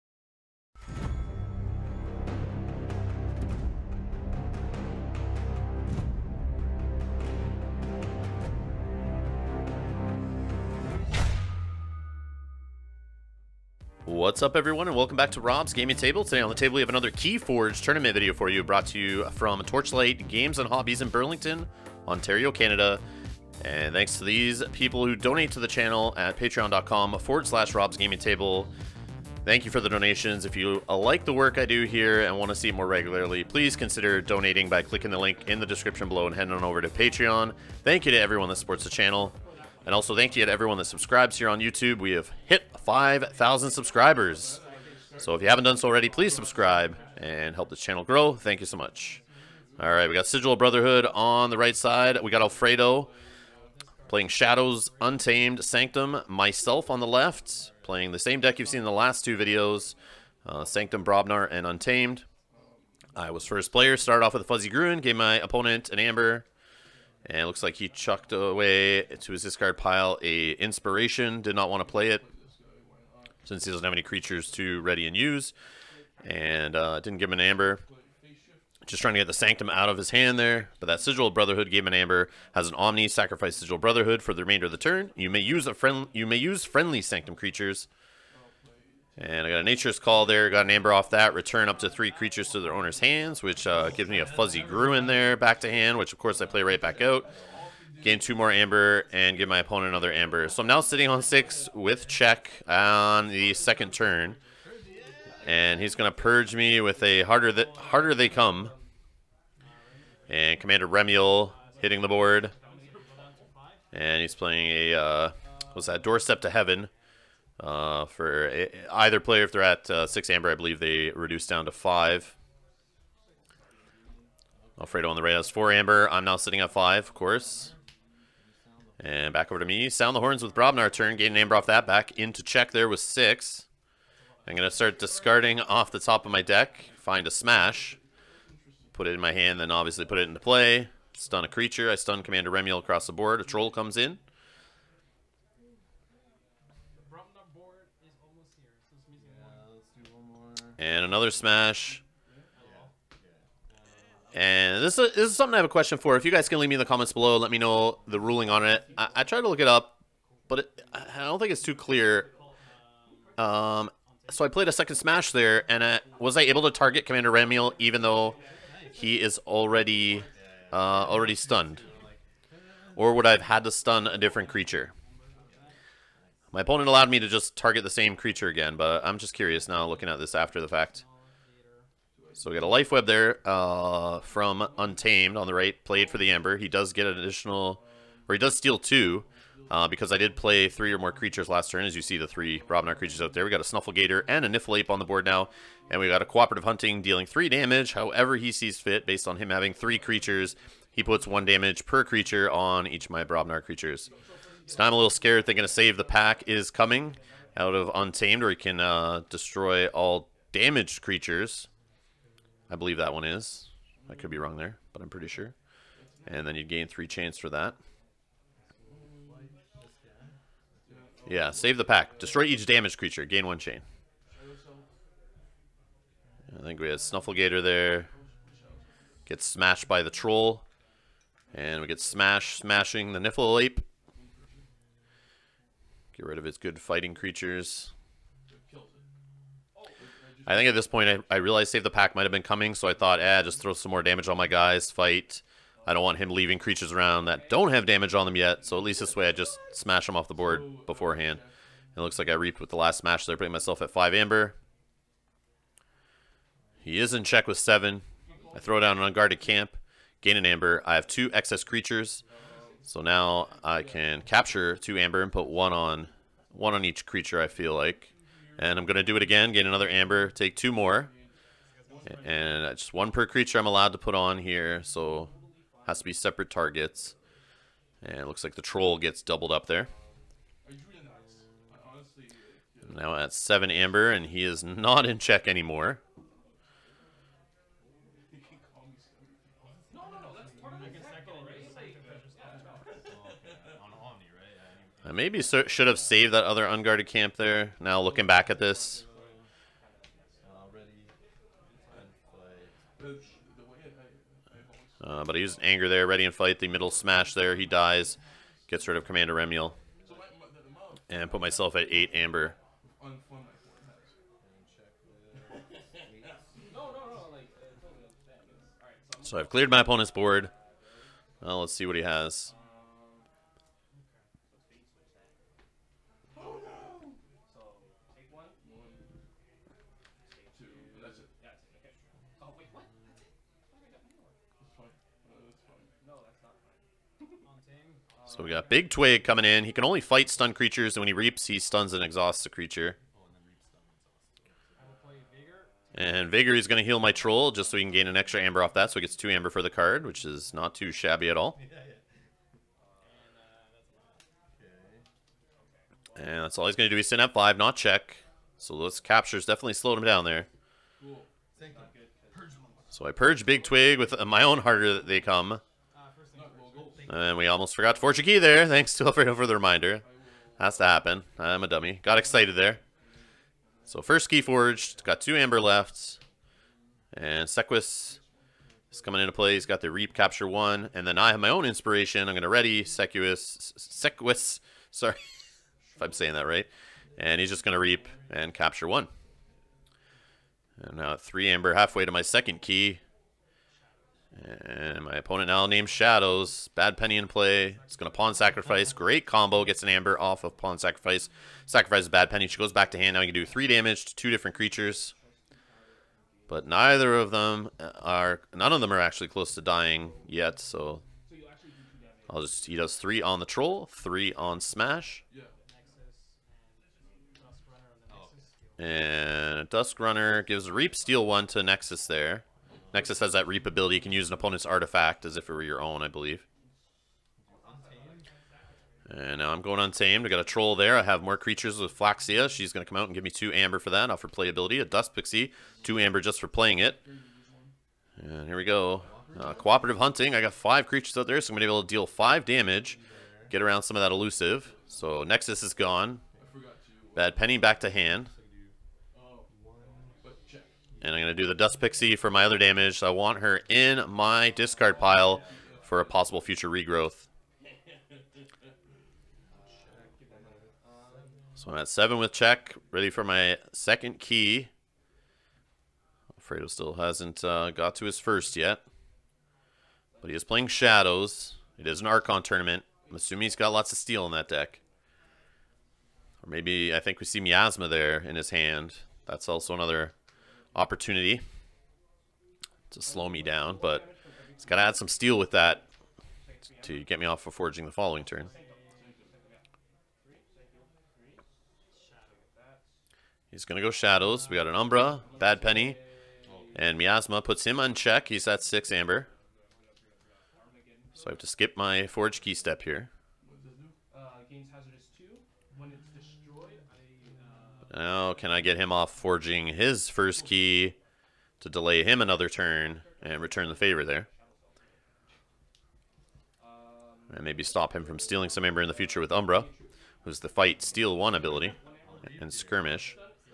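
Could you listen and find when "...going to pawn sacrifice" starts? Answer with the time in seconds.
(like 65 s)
397 s.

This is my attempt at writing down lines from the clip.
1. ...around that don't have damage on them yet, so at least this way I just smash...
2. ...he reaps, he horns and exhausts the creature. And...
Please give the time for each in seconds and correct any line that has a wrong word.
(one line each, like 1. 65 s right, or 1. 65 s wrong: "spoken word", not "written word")
1. 246 s right
2. 341 s wrong: "stuns", not "horns".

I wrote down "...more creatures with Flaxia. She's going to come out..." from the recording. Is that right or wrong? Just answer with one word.
right.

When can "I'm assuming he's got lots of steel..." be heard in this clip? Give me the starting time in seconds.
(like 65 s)
473 s.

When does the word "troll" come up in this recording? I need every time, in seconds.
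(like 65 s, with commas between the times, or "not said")
143 s, 230 s, 278 s, 347 s, 413 s, 430 s.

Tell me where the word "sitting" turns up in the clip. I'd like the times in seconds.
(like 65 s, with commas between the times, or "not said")
100 s, 126 s, 357 s.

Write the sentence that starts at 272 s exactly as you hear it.
And just one per creature I'm allowed to put on here, so has to be separate targets.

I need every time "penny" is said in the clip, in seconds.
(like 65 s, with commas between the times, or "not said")
396 s, 402 s, 447 s, 495 s.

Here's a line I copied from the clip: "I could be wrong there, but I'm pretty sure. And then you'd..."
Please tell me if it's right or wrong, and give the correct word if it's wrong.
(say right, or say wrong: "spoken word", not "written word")
right.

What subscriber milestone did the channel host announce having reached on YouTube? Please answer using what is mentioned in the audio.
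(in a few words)
5,000.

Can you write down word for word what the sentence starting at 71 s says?
Did not want to play it since he doesn't have any creatures to ready and use.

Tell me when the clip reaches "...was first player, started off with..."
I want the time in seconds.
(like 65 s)
63 s.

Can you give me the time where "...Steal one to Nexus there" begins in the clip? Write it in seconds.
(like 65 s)
420 s.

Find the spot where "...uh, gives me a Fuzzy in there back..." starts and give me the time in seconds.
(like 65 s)
93 s.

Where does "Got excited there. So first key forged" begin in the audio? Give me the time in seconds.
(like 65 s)
372 s.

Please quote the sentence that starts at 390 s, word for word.
And now three amber halfway to my second key.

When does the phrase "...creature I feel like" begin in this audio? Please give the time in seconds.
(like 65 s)
267 s.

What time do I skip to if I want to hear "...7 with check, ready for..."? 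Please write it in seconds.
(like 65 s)
461 s.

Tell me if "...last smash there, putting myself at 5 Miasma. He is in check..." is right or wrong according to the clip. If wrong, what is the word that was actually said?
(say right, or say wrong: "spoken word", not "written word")
wrong: "Amber", not "Miasma".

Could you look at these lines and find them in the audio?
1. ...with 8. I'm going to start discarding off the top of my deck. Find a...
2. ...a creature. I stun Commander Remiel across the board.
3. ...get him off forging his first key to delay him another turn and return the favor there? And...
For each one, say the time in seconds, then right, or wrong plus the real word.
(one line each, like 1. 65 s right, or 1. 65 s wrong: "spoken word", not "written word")
1. 132 s wrong: "6", not "8"
2. 141 s right
3. 508 s right.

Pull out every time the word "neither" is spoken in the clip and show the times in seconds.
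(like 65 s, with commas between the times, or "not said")
406 s.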